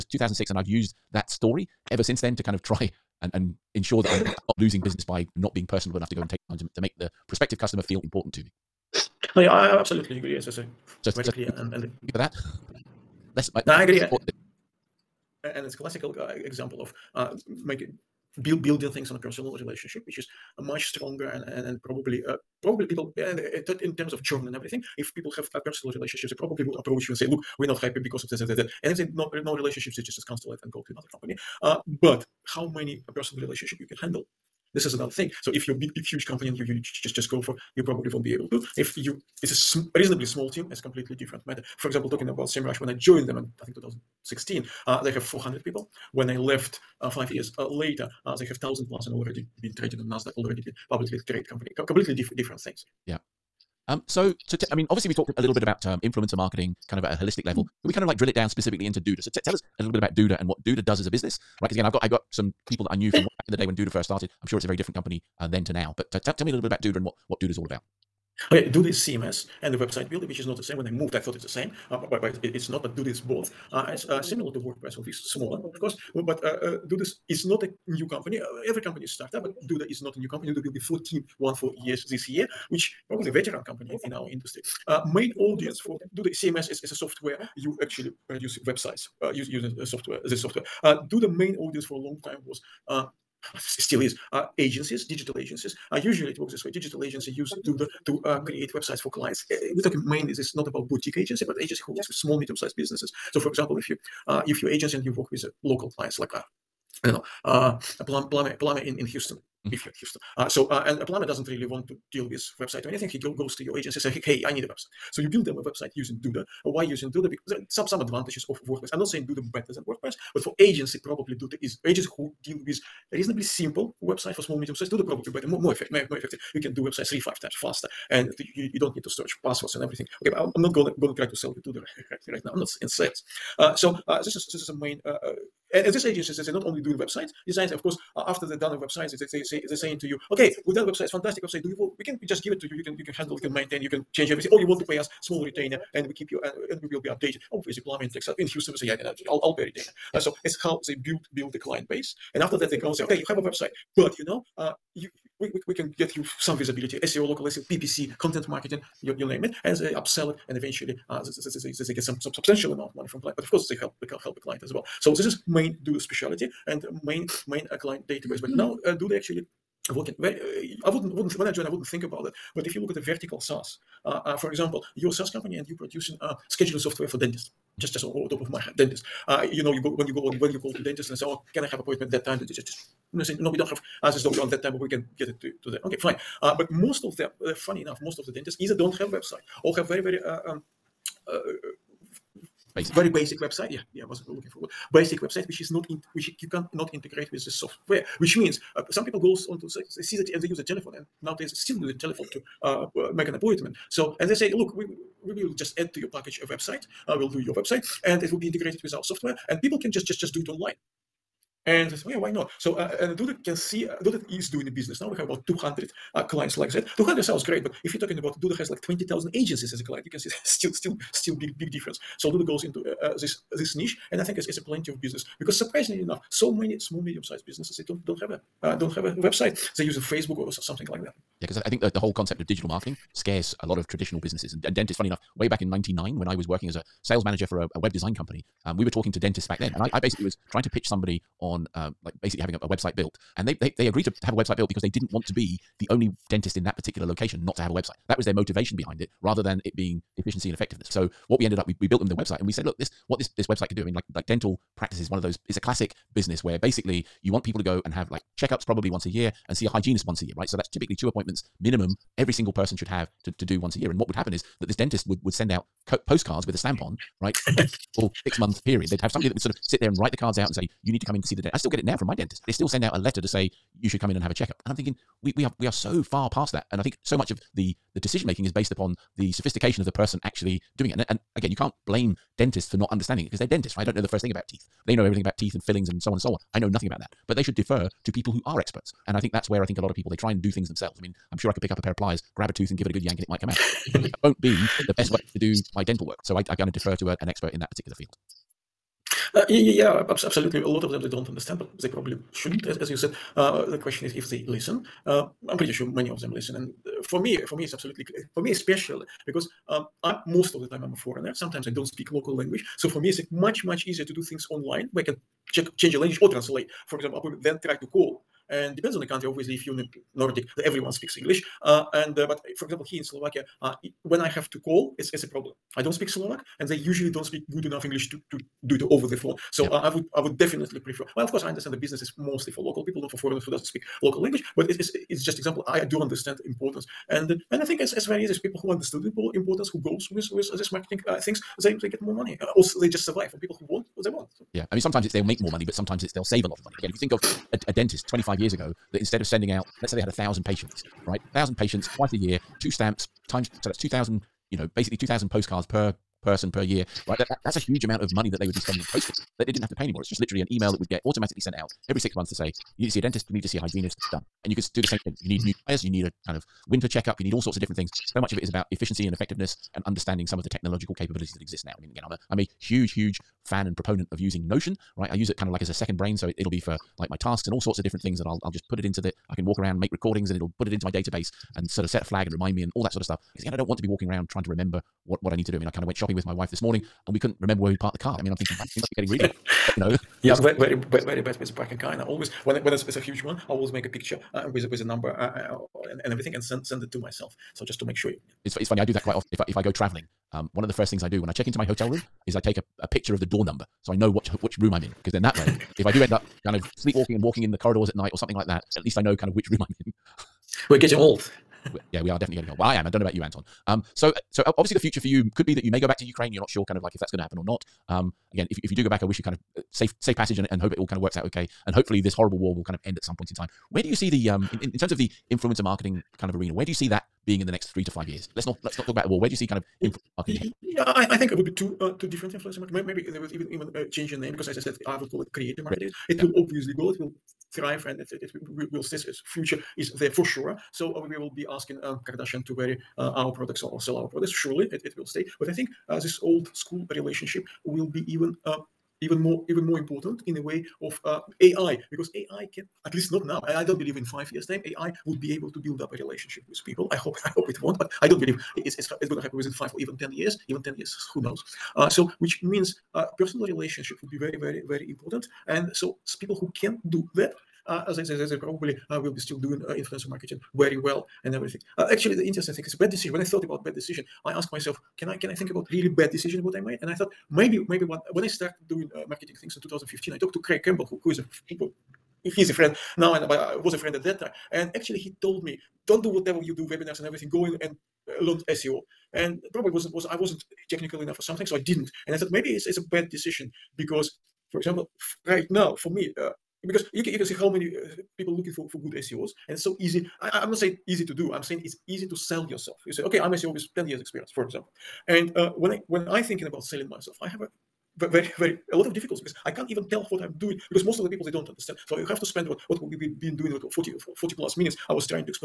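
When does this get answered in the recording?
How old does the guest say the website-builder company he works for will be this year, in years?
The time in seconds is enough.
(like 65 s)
80 s.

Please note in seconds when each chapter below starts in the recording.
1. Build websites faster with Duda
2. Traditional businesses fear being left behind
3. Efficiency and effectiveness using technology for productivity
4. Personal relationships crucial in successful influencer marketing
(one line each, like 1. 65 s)
1. 114 s
2. 231 s
3. 367 s
4. 456 s.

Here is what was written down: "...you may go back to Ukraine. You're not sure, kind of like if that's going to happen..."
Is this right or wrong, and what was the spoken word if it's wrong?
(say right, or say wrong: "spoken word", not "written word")
right.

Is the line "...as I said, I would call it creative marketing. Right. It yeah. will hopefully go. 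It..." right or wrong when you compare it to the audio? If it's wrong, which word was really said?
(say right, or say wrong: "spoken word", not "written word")
wrong: "obviously", not "hopefully".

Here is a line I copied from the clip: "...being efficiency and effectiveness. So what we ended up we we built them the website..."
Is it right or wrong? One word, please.
right.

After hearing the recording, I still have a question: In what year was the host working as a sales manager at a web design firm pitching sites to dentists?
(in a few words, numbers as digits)
1999.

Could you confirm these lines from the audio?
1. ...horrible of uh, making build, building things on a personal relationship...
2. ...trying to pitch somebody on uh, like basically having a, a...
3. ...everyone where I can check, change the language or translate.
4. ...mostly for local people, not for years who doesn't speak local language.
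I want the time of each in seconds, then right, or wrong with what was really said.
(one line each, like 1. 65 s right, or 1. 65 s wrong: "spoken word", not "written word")
1. 16 s wrong: "example", not "horrible"
2. 240 s right
3. 314 s wrong: "online", not "everyone"
4. 332 s wrong: "foreigners", not "years".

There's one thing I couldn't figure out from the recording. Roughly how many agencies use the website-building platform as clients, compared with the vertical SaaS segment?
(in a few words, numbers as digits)
20,000.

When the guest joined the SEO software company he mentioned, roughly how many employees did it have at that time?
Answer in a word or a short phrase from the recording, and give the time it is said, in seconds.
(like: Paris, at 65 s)
400, at 45 s.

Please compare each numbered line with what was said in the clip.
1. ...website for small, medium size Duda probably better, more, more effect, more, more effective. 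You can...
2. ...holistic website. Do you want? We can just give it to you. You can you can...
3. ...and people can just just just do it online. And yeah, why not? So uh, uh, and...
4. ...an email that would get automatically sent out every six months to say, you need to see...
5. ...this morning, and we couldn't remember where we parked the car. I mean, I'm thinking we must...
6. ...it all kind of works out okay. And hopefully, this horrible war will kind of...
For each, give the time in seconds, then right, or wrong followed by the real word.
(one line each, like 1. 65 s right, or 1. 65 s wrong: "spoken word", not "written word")
1. 124 s right
2. 141 s wrong: "fantastic", not "holistic"
3. 209 s right
4. 360 s right
5. 386 s right
6. 420 s right.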